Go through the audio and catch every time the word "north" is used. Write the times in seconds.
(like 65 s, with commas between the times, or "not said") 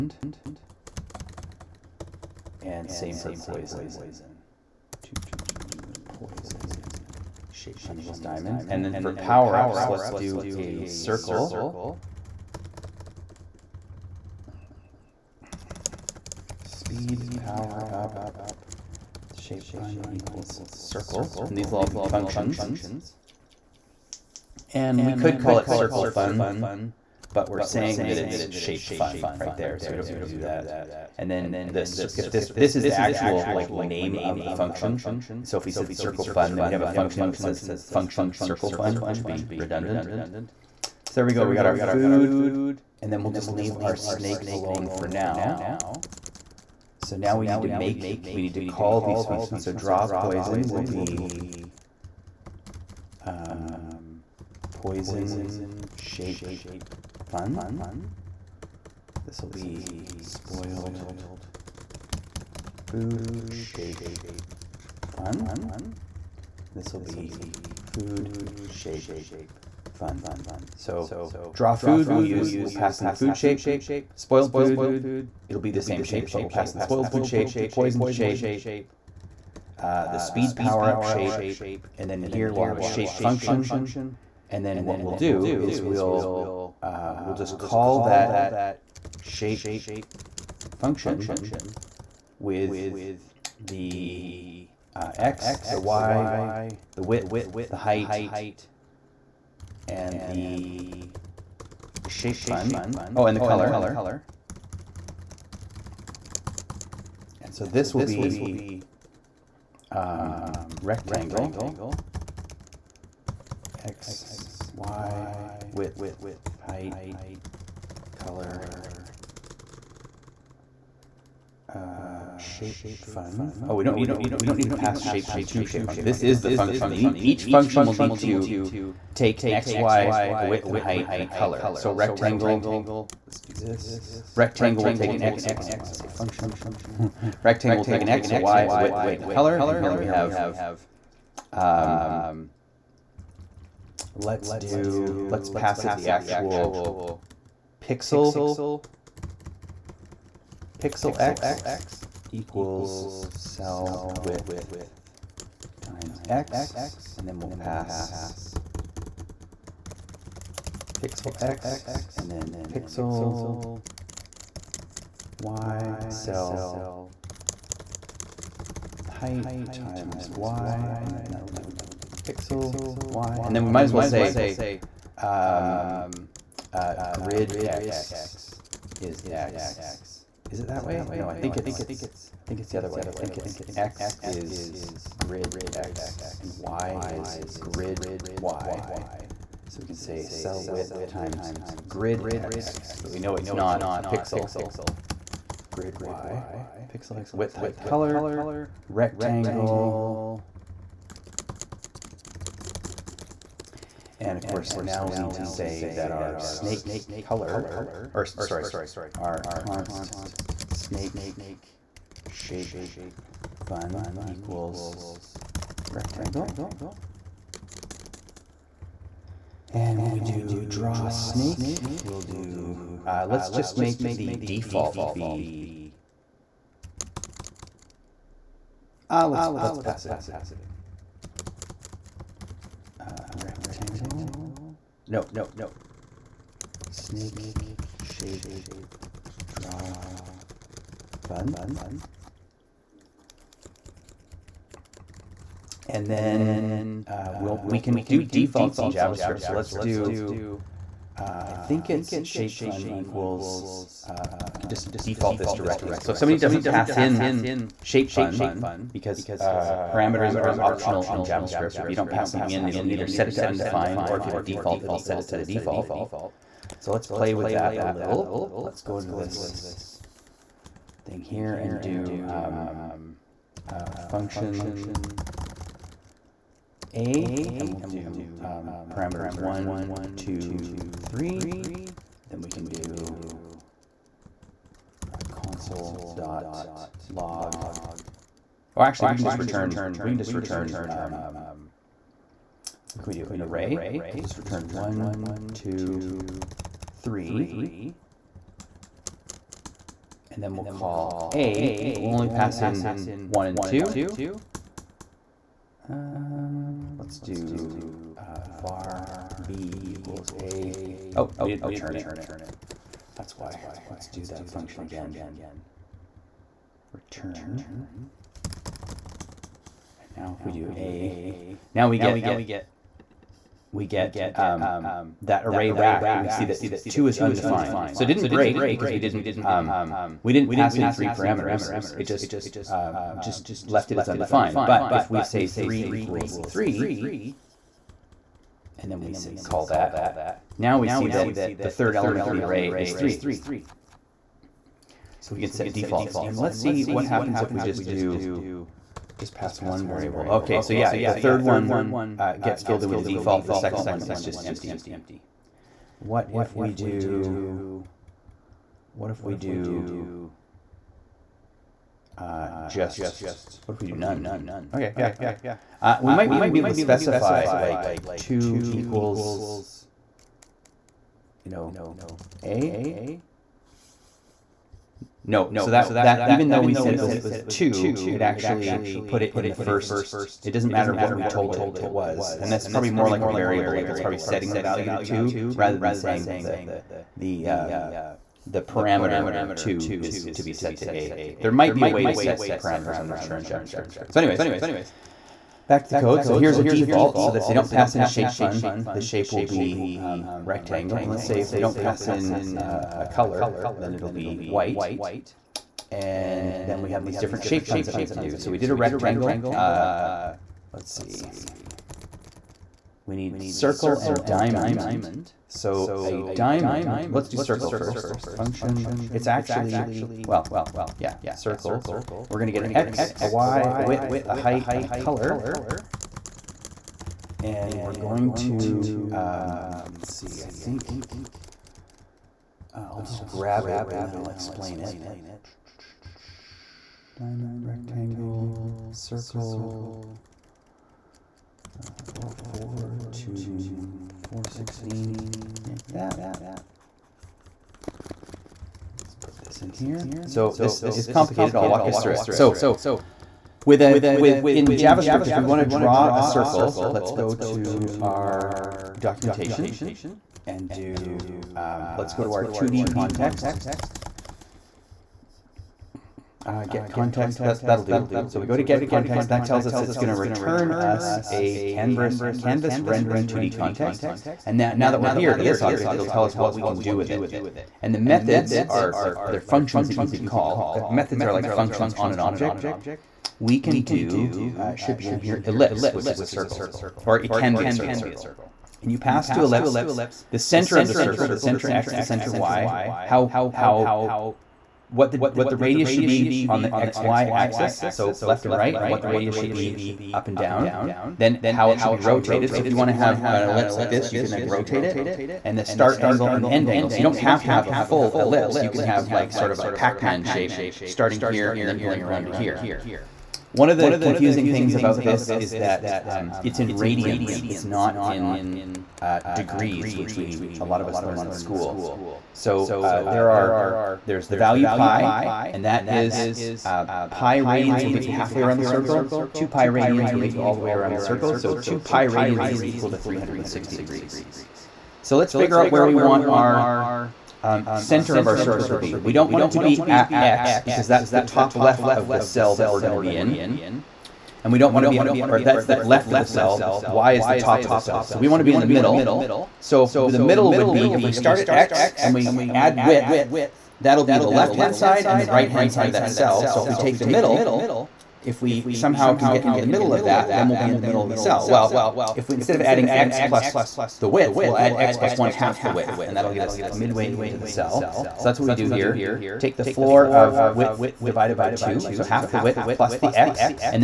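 not said.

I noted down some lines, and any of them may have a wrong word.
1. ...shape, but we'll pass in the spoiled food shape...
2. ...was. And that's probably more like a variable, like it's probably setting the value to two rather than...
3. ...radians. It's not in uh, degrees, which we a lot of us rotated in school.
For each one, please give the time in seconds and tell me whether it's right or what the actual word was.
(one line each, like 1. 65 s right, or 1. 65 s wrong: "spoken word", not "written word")
1. 76 s right
2. 381 s right
3. 516 s wrong: "learned", not "rotated".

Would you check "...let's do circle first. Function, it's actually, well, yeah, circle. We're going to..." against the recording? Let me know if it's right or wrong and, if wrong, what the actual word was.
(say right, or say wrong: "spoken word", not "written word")
right.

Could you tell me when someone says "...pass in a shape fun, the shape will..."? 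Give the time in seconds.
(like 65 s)
397 s.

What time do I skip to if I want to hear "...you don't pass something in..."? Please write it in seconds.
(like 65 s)
261 s.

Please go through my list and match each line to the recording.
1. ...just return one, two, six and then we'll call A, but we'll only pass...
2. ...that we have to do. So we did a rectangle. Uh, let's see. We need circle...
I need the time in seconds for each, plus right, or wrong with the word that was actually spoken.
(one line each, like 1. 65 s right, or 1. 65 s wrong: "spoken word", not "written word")
1. 294 s wrong: "three", not "six"
2. 407 s right.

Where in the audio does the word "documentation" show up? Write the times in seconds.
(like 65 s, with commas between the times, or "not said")
458 s.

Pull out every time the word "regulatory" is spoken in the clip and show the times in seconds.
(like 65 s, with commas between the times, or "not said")
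not said.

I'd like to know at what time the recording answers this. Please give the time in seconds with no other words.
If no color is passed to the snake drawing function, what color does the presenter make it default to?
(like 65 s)
404 s.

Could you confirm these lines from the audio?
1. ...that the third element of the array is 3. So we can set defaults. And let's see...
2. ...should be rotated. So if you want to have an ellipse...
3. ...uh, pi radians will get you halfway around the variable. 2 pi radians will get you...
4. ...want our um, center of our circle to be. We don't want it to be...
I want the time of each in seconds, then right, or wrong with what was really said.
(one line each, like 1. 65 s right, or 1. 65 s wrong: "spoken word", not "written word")
1. 341 s right
2. 501 s right
3. 526 s wrong: "circle", not "variable"
4. 535 s right.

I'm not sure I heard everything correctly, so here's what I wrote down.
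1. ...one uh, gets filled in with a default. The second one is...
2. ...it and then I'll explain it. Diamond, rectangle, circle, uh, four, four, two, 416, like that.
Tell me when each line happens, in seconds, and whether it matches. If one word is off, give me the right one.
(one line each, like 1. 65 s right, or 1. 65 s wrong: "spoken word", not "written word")
1. 351 s right
2. 433 s right.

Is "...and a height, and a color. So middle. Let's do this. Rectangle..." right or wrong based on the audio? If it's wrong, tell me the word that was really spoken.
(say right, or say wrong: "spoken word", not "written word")
wrong: "rectangle", not "middle".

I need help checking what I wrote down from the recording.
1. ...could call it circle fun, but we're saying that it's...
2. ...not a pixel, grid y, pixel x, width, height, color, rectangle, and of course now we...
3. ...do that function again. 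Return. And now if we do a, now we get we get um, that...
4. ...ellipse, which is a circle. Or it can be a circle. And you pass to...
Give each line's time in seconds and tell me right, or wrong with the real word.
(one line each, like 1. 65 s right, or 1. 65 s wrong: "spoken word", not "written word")
1. 25 s right
2. 193 s right
3. 314 s right
4. 485 s right.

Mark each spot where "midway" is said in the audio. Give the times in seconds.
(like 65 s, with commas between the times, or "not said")
566 s.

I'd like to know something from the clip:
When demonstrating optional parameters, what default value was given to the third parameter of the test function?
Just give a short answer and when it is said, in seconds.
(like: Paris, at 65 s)
3, at 335 s.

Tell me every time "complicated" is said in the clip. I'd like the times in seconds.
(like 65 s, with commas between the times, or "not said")
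451 s.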